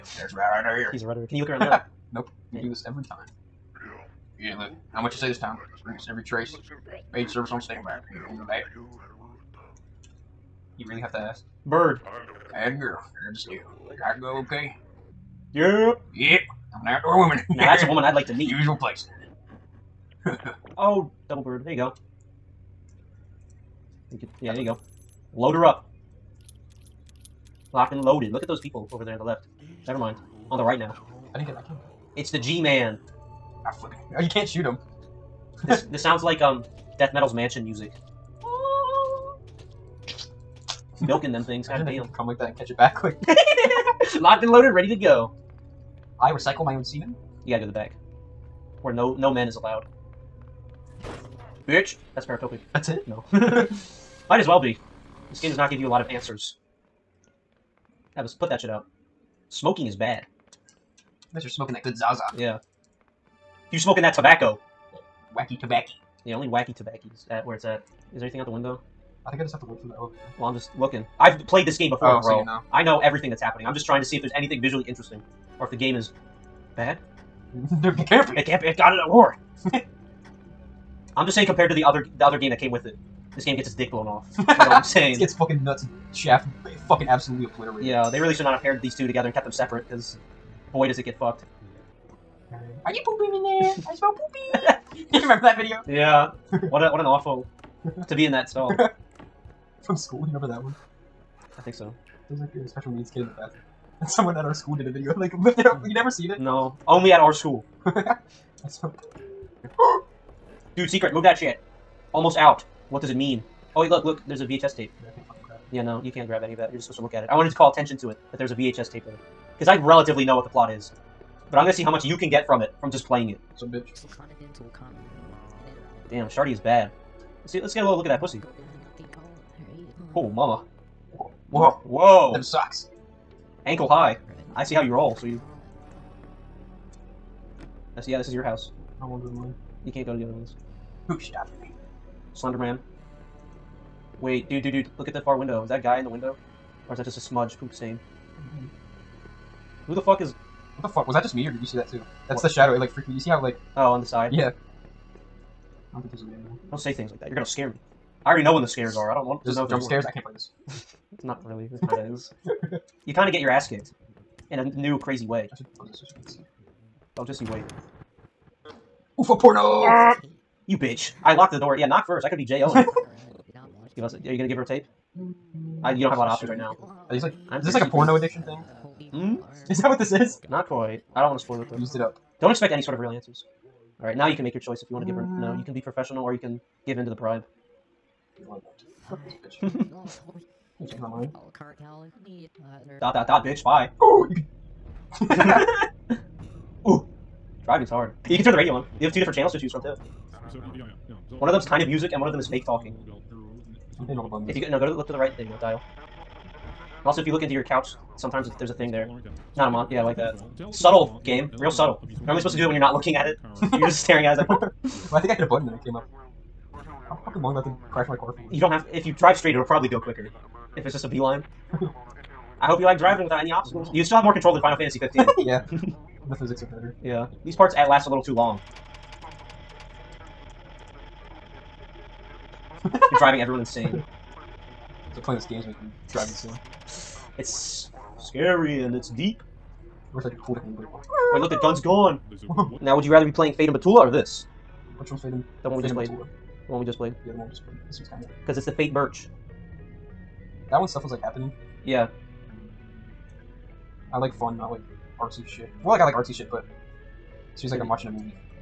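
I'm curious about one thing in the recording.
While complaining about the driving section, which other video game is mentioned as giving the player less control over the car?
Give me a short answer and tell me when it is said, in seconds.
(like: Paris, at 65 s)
Final Fantasy 15, at 224 s.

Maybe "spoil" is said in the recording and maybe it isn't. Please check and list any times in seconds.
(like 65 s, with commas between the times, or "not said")
181 s.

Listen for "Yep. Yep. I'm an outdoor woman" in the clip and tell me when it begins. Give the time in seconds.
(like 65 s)
15 s.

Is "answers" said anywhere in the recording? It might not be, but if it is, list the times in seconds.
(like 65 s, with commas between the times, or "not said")
56 s, 183 s.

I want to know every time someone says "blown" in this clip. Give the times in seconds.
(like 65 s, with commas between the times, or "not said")
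83 s.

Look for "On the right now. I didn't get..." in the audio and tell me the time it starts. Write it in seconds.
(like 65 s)
30 s.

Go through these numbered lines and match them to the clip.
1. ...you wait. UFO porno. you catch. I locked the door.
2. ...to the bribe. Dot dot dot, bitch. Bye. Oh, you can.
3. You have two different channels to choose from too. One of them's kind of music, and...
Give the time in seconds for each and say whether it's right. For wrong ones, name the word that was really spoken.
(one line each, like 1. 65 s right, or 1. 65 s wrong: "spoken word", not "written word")
1. 167 s wrong: "bitch", not "catch"
2. 187 s right
3. 198 s right.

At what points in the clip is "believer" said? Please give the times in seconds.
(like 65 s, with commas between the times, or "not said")
not said.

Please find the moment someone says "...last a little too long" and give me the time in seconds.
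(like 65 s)
227 s.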